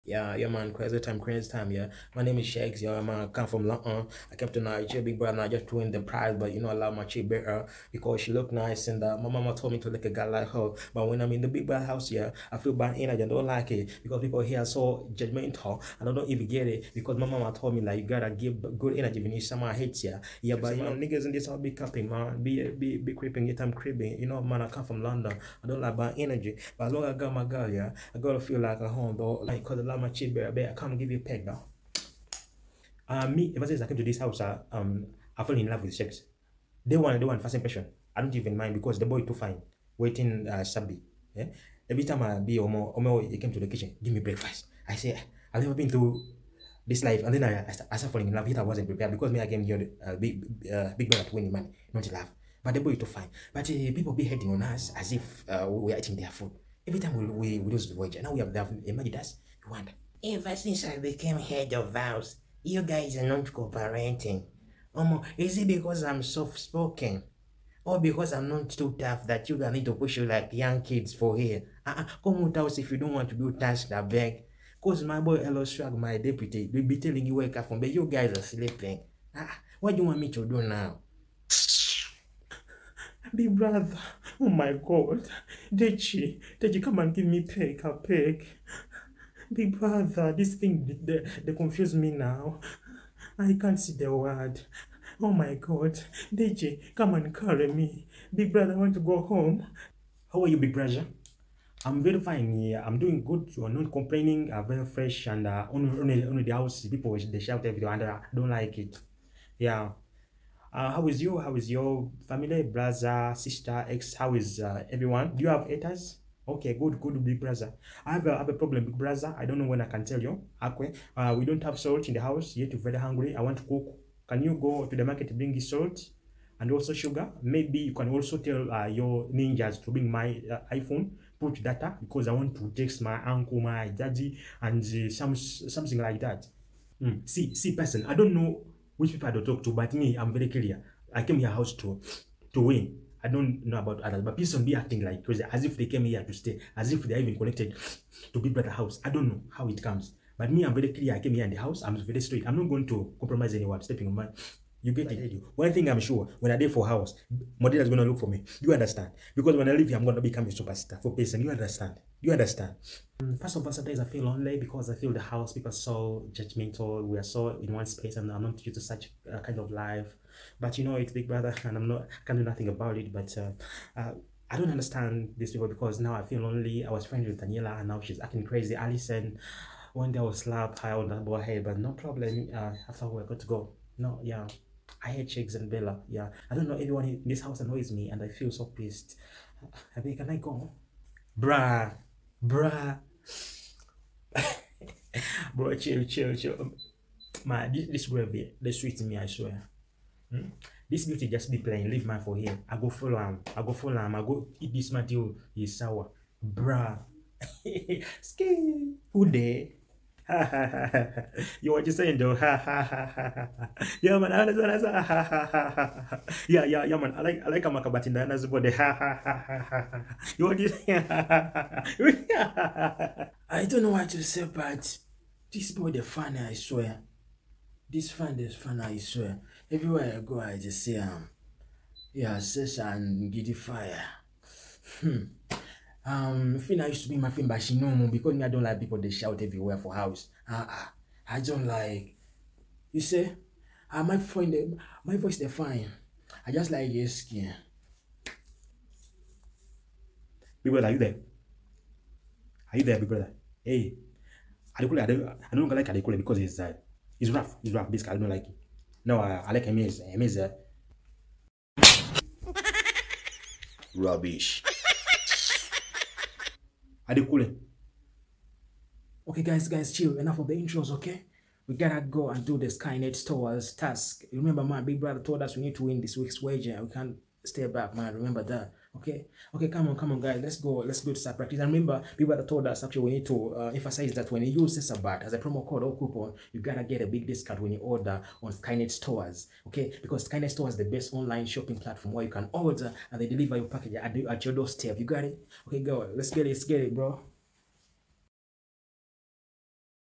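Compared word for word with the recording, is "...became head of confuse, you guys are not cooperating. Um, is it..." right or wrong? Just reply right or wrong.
wrong.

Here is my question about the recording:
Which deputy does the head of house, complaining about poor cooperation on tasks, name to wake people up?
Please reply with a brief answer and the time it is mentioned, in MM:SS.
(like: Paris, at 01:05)
Eloswag, at 01:15.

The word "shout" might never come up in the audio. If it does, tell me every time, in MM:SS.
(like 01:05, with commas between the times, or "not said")
01:47, 03:59.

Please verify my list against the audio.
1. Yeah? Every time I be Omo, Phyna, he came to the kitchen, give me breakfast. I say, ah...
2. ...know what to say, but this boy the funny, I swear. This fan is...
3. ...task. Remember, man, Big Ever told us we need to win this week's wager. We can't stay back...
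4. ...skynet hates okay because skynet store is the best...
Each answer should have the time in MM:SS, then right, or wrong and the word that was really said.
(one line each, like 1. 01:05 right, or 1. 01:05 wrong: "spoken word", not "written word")
1. 00:41 wrong: "Omo", not "Phyna"
2. 03:43 right
3. 04:33 wrong: "Brother", not "Ever"
4. 04:48 wrong: "stores", not "hates".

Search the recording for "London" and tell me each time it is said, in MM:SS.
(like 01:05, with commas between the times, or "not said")
00:03, 00:25.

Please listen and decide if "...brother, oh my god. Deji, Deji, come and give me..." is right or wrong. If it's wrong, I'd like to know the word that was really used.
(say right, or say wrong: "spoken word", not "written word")
right.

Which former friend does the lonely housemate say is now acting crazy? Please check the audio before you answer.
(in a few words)
Daniella.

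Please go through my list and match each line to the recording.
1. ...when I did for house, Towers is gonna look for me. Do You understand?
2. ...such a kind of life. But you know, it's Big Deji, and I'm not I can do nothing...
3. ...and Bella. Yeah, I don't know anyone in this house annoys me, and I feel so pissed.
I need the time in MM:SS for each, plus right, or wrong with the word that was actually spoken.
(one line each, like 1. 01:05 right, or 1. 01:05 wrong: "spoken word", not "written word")
1. 02:36 wrong: "Modena", not "Towers"
2. 02:48 wrong: "Brother", not "Deji"
3. 03:05 right.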